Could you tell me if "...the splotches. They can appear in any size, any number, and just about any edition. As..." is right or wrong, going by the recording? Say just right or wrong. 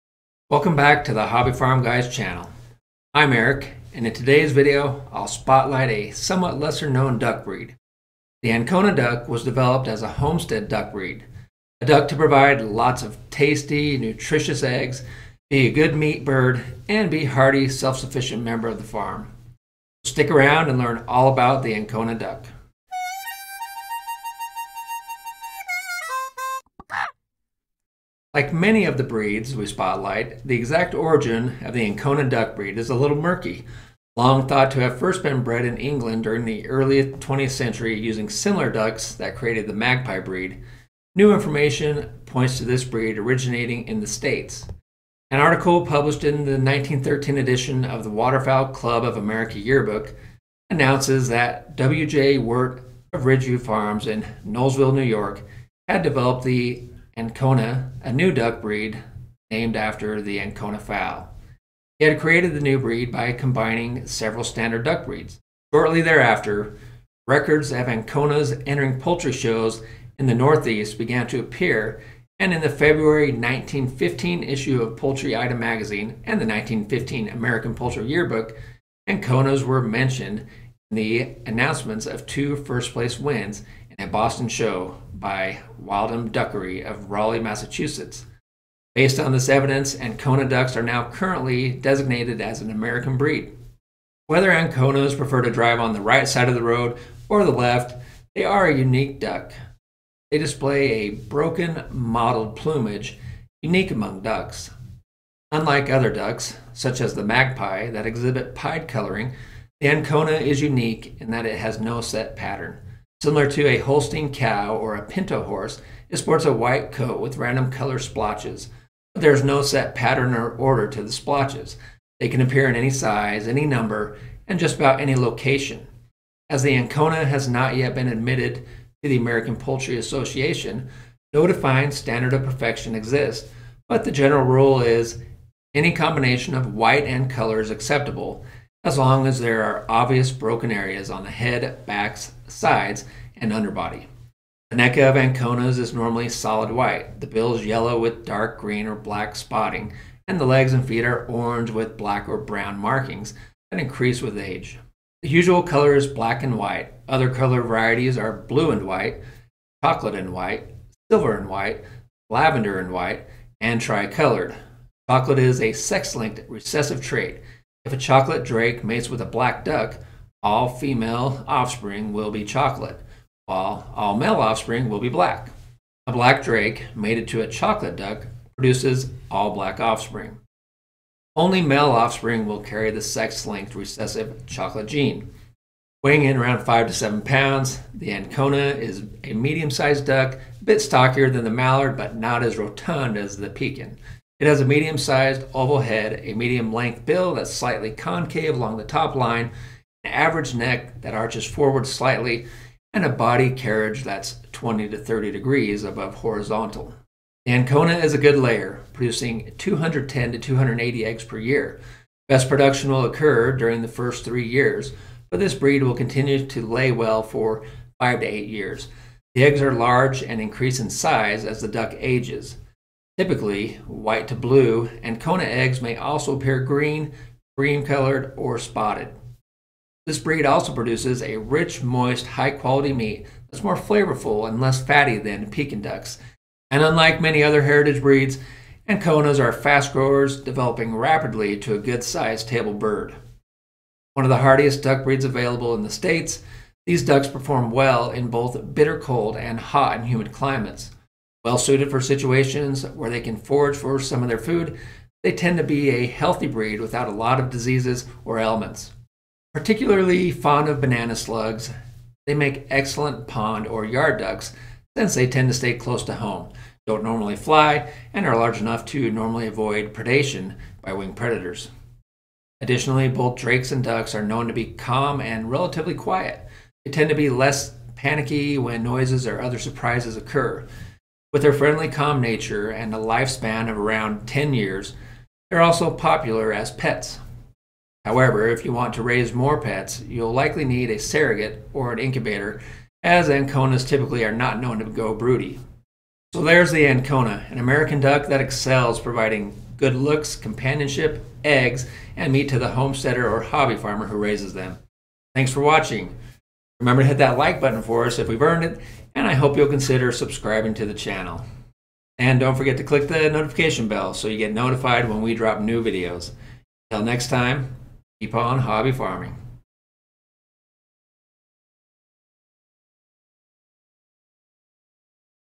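wrong.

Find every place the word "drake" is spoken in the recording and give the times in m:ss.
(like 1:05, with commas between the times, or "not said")
2:48, 2:56, 4:33.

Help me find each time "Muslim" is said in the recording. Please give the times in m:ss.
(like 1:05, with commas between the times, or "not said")
not said.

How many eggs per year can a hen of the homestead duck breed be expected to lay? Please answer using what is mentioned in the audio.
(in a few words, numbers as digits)
210 to 280.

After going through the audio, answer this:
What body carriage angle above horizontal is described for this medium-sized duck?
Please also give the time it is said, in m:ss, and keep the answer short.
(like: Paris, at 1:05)
20 to 30 degrees, at 3:24.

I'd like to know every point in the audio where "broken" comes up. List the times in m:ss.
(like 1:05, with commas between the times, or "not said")
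1:41, 2:20.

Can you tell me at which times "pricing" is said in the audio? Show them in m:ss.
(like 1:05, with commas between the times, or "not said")
not said.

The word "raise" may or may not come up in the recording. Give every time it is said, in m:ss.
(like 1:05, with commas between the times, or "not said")
4:49, 5:04.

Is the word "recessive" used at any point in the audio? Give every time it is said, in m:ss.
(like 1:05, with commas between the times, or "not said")
2:46, 3:03.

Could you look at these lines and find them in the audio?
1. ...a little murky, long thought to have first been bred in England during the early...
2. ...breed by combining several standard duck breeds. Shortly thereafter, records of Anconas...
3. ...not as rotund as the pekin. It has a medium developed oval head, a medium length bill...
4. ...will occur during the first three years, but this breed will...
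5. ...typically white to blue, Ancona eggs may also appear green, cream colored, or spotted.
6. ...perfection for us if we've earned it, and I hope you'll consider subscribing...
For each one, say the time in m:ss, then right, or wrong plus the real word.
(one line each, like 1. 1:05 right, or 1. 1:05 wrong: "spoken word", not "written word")
1. 0:32 right
2. 1:02 right
3. 3:12 wrong: "sized", not "developed"
4. 3:32 right
5. 3:43 right
6. 5:07 wrong: "button", not "perfection".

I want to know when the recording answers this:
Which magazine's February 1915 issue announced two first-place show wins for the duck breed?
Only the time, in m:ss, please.
1:14.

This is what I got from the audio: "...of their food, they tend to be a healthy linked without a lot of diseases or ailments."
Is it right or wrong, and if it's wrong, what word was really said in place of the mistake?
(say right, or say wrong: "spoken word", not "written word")
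wrong: "breed", not "linked".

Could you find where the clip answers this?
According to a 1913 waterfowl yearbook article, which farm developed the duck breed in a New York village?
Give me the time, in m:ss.
0:53.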